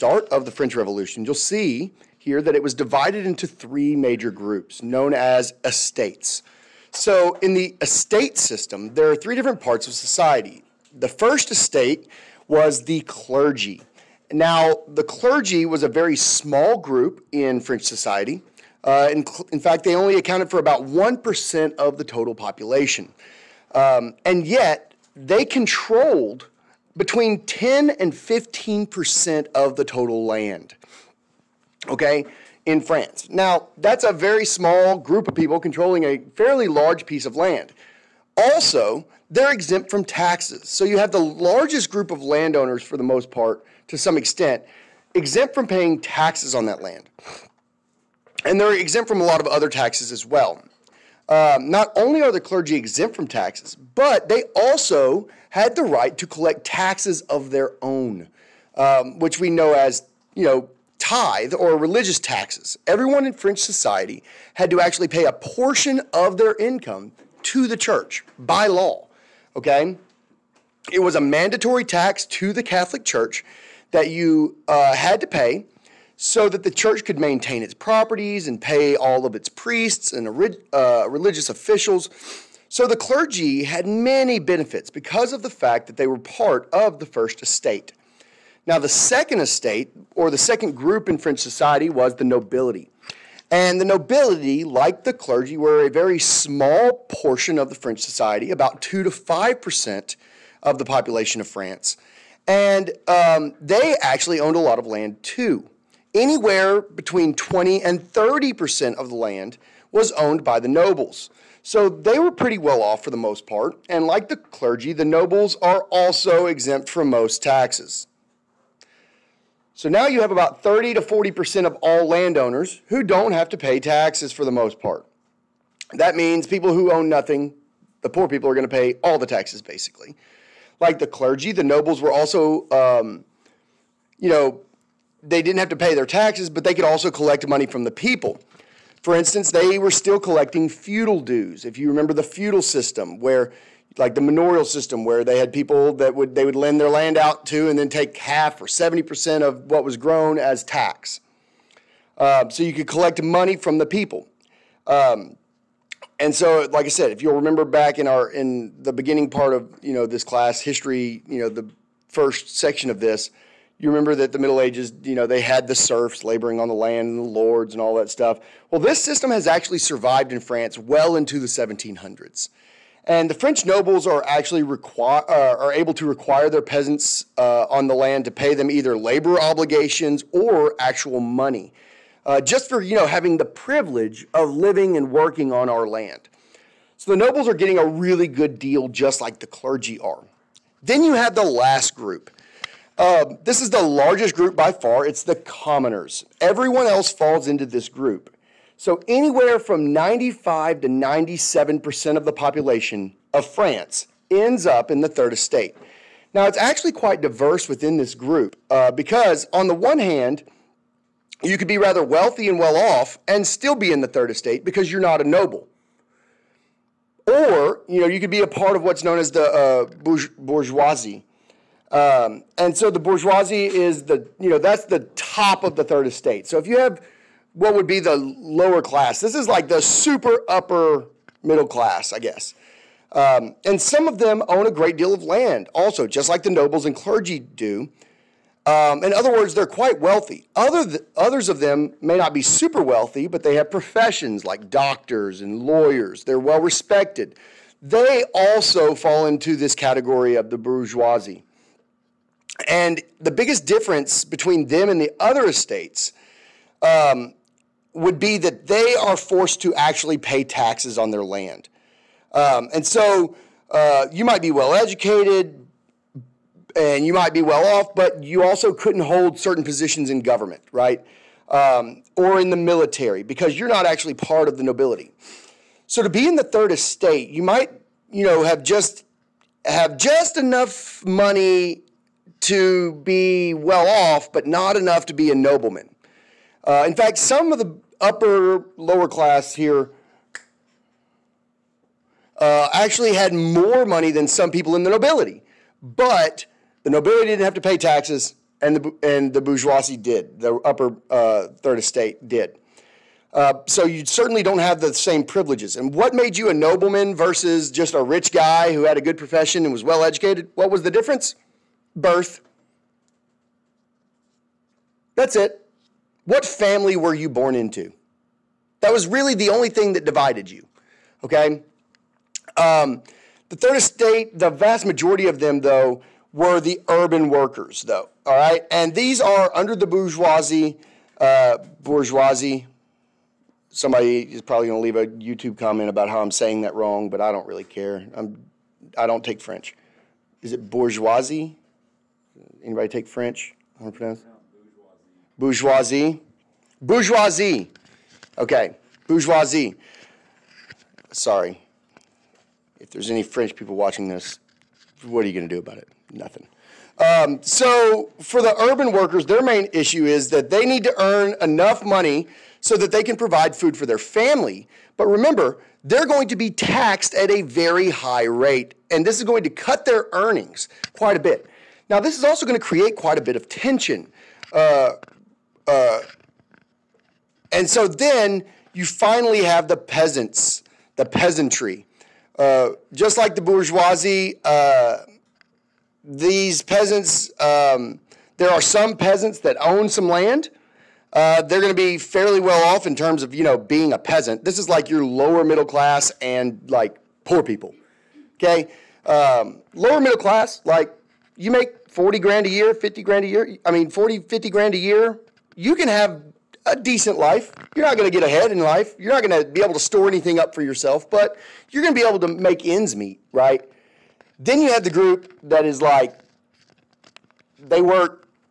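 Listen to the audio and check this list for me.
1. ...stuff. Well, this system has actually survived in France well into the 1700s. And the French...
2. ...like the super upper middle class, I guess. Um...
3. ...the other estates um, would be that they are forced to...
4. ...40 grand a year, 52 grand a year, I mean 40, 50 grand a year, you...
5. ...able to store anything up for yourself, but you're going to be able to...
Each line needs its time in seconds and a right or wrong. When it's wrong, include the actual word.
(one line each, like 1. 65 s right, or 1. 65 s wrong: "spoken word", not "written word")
1. 168 s right
2. 229 s right
3. 255 s right
4. 401 s wrong: "50", not "52"
5. 409 s right.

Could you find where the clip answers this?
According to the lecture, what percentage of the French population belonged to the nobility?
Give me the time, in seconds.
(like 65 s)
98 s.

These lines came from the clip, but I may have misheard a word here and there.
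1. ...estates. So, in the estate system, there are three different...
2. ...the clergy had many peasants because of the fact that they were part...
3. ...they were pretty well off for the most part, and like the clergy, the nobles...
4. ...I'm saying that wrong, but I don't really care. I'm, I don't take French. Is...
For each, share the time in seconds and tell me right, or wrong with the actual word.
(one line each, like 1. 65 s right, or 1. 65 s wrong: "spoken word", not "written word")
1. 5 s right
2. 82 s wrong: "benefits", not "peasants"
3. 111 s right
4. 336 s right.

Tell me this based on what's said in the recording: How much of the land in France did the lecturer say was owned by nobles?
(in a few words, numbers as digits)
20 to 30%.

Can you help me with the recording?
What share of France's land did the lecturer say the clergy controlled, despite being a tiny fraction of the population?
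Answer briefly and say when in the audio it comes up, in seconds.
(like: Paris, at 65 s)
10 to 15%, at 26 s.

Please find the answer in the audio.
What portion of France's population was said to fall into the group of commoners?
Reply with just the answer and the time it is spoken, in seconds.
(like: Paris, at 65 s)
95 to 97%, at 199 s.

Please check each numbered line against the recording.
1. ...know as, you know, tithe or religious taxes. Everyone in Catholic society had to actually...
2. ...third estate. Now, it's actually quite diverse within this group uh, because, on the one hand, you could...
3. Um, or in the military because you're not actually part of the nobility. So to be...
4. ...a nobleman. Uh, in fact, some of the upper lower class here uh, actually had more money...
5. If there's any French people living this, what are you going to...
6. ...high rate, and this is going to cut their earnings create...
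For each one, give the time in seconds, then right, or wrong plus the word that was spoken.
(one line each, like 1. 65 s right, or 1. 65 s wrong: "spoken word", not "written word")
1. 59 s wrong: "French", not "Catholic"
2. 205 s right
3. 271 s right
4. 285 s right
5. 352 s wrong: "watching", not "living"
6. 367 s wrong: "quite", not "create".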